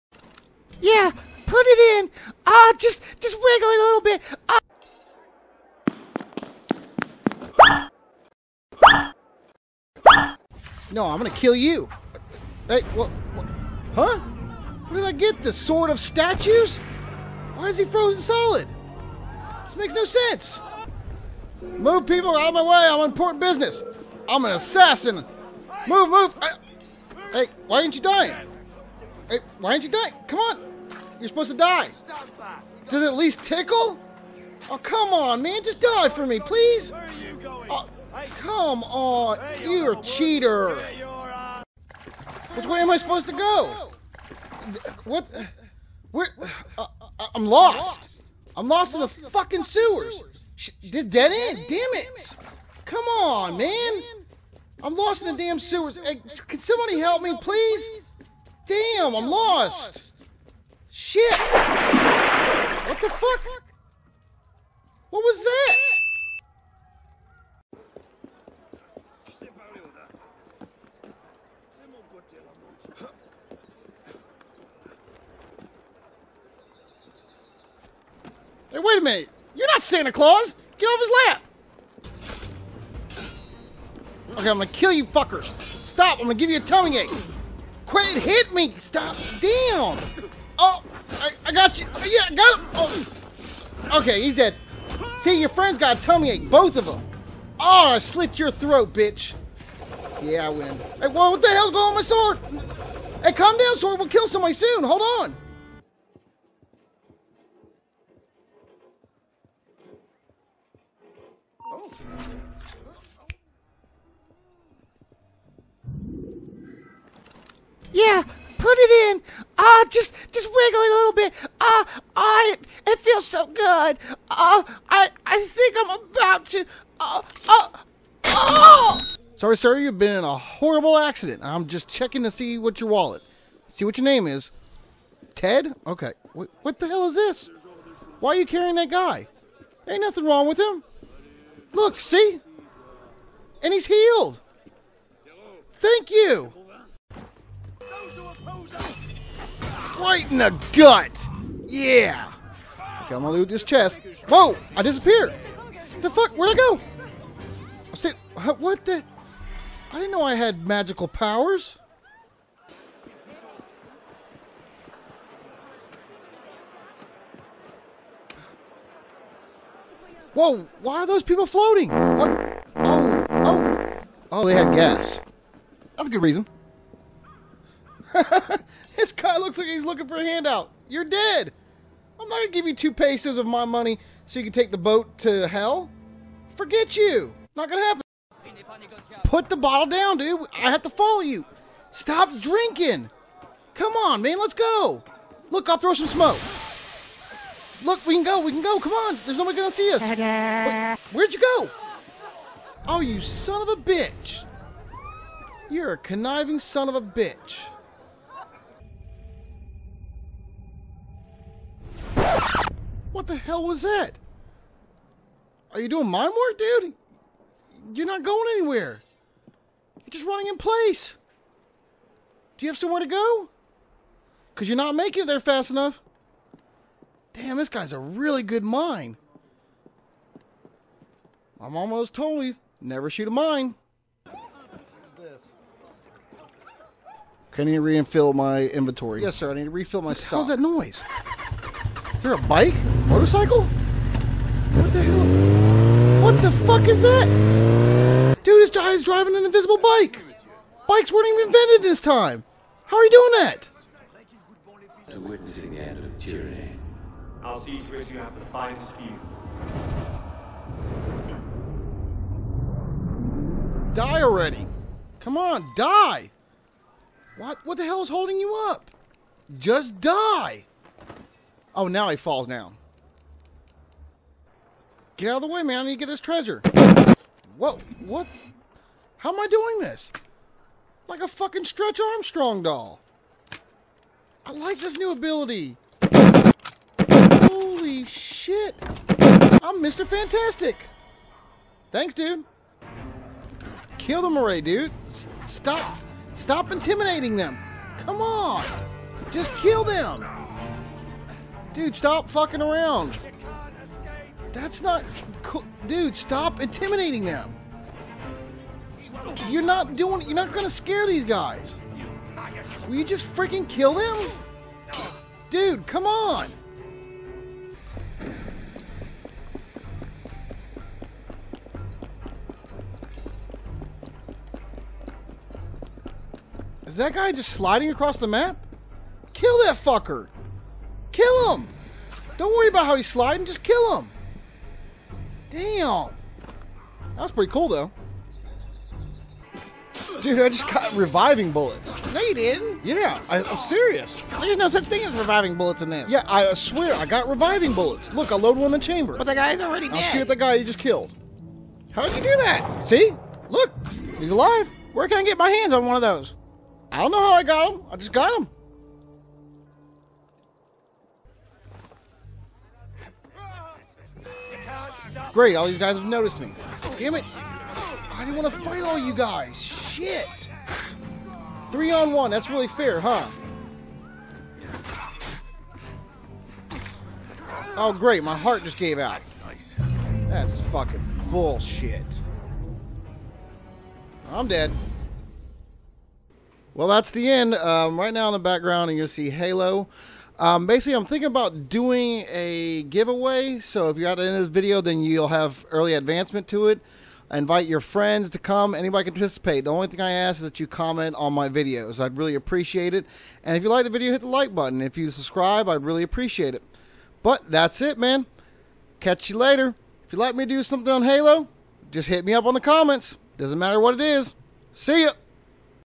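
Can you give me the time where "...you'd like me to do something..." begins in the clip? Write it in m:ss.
6:50.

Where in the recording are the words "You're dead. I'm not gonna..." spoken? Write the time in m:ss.
3:00.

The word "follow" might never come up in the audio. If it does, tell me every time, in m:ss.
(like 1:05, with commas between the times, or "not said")
3:10.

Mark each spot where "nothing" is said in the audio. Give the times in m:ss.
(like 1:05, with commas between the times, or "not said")
2:20.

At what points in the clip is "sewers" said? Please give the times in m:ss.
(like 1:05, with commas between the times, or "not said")
0:49, 0:55.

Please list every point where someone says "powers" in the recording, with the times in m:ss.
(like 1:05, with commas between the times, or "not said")
2:41.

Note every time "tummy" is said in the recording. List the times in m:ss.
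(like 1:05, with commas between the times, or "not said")
1:26, 1:36.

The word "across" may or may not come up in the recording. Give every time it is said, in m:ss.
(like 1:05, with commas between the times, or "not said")
5:27.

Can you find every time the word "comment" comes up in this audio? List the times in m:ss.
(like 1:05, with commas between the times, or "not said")
6:40, 6:52.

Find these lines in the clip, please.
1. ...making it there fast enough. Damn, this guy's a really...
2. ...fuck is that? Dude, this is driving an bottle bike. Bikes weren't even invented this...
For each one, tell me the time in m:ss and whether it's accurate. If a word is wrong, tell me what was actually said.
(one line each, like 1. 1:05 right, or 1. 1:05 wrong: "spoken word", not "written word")
1. 3:44 right
2. 4:06 wrong: "invisible", not "bottle".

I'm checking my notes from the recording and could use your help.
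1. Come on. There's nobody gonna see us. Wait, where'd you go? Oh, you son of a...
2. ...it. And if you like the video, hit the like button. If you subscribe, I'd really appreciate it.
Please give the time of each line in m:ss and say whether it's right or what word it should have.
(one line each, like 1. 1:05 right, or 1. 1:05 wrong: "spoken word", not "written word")
1. 3:18 right
2. 6:42 right.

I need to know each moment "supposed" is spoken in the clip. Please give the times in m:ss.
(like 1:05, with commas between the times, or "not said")
0:31, 0:42.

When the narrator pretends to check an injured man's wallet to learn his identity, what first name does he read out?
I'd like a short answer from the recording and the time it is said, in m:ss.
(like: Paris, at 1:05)
Ted, at 2:15.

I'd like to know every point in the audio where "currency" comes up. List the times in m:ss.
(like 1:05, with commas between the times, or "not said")
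not said.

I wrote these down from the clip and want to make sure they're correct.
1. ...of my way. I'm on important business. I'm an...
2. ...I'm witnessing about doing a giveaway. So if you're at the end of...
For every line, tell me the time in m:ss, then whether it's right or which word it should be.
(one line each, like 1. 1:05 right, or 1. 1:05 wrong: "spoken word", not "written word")
1. 0:22 right
2. 6:30 wrong: "thinking", not "witnessing".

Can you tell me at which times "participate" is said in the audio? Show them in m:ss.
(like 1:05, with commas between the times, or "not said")
6:39.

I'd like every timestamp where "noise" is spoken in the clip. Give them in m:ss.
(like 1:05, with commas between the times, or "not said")
4:00.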